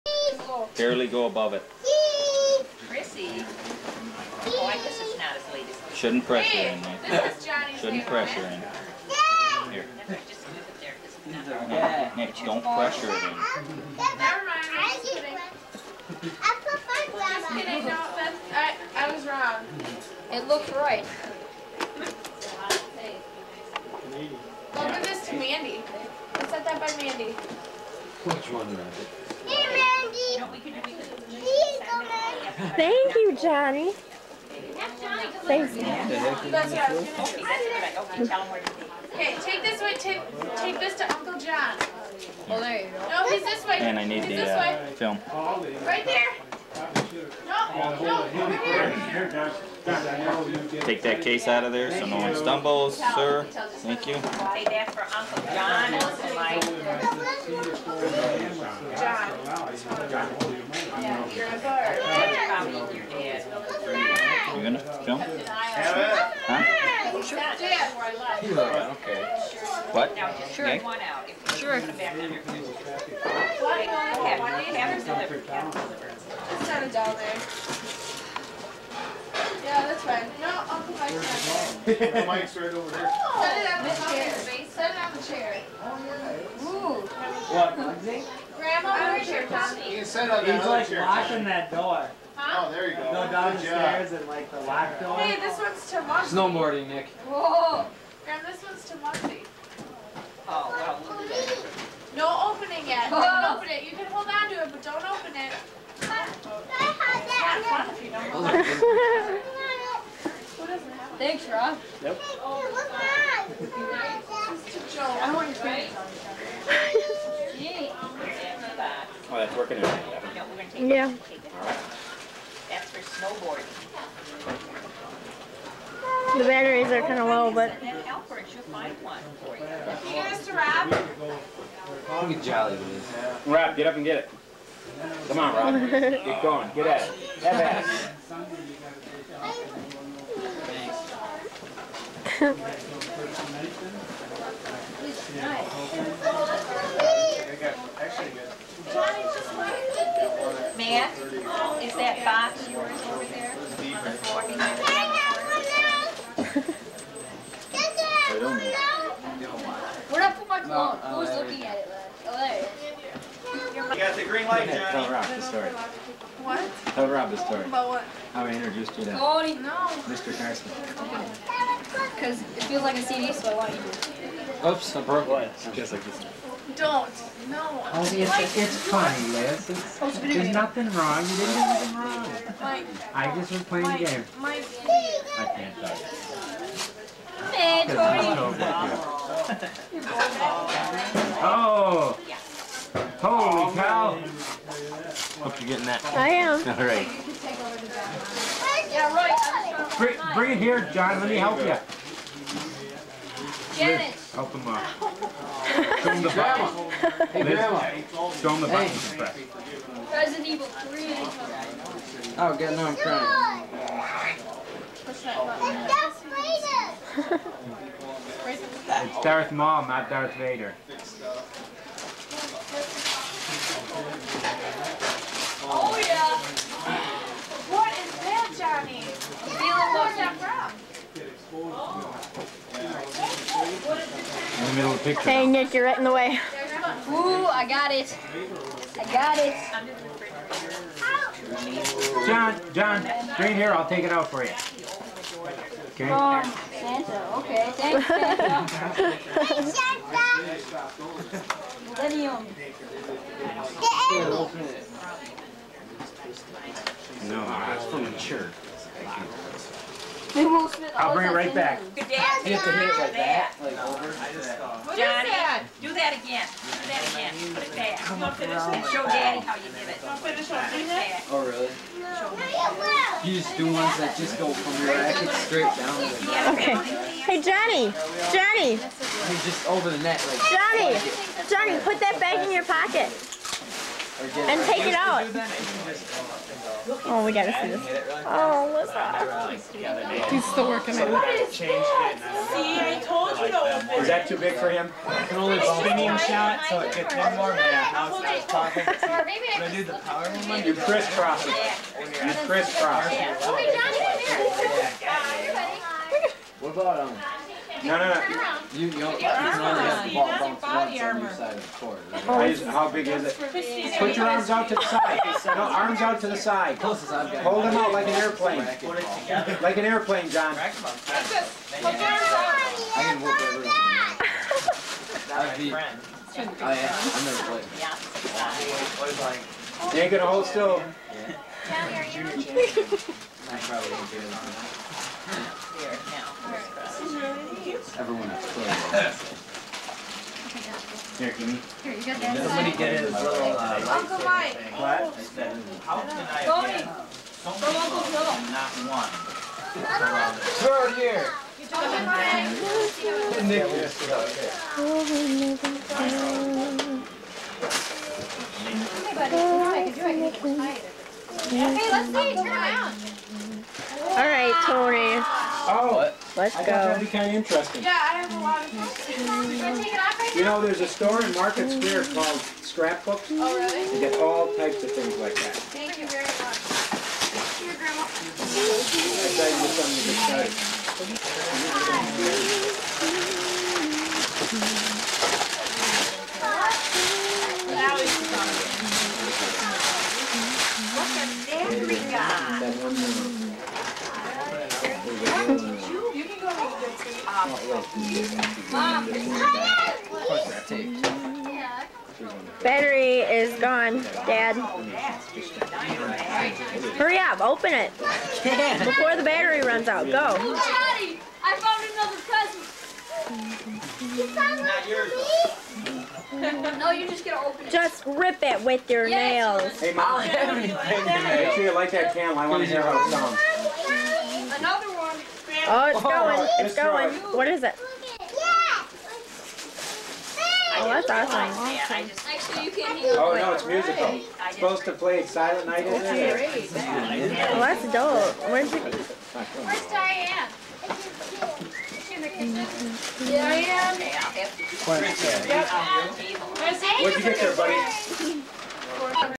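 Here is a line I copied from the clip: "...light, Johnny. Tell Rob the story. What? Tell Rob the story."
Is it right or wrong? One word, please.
right.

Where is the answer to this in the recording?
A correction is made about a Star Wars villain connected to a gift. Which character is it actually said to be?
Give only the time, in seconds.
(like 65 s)
219 s.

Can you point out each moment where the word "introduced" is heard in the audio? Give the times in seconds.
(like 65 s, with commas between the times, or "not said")
168 s.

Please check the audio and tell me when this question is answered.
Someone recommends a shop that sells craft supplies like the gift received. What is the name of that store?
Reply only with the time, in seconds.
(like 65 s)
372 s.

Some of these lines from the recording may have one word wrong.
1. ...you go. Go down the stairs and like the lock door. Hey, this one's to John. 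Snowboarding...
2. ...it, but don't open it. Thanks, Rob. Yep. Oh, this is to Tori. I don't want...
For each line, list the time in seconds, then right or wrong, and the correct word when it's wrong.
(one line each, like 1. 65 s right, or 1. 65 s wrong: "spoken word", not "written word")
1. 92 s wrong: "Mugsy", not "John"
2. 104 s wrong: "Joe", not "Tori".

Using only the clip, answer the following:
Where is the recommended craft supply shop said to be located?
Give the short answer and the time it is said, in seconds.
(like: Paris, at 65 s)
Market Square, at 371 s.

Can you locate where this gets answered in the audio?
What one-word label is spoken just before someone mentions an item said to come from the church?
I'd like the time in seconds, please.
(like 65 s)
251 s.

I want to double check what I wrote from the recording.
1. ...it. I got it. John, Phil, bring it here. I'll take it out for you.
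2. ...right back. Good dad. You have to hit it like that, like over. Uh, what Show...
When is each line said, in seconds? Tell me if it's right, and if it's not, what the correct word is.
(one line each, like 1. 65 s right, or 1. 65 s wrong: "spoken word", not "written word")
1. 237 s wrong: "John", not "Phil"
2. 261 s wrong: "Johnny", not "Show".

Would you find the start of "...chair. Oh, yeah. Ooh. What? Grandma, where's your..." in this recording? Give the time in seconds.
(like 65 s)
85 s.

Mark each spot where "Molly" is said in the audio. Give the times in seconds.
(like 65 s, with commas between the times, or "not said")
419 s.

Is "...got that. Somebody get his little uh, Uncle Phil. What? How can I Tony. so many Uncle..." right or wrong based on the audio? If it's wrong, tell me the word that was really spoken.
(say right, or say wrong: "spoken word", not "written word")
wrong: "Mike", not "Phil".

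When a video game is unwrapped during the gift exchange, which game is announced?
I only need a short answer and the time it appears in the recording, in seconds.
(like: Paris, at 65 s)
Resident Evil 3, at 210 s.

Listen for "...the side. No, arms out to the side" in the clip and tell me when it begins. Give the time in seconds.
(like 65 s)
314 s.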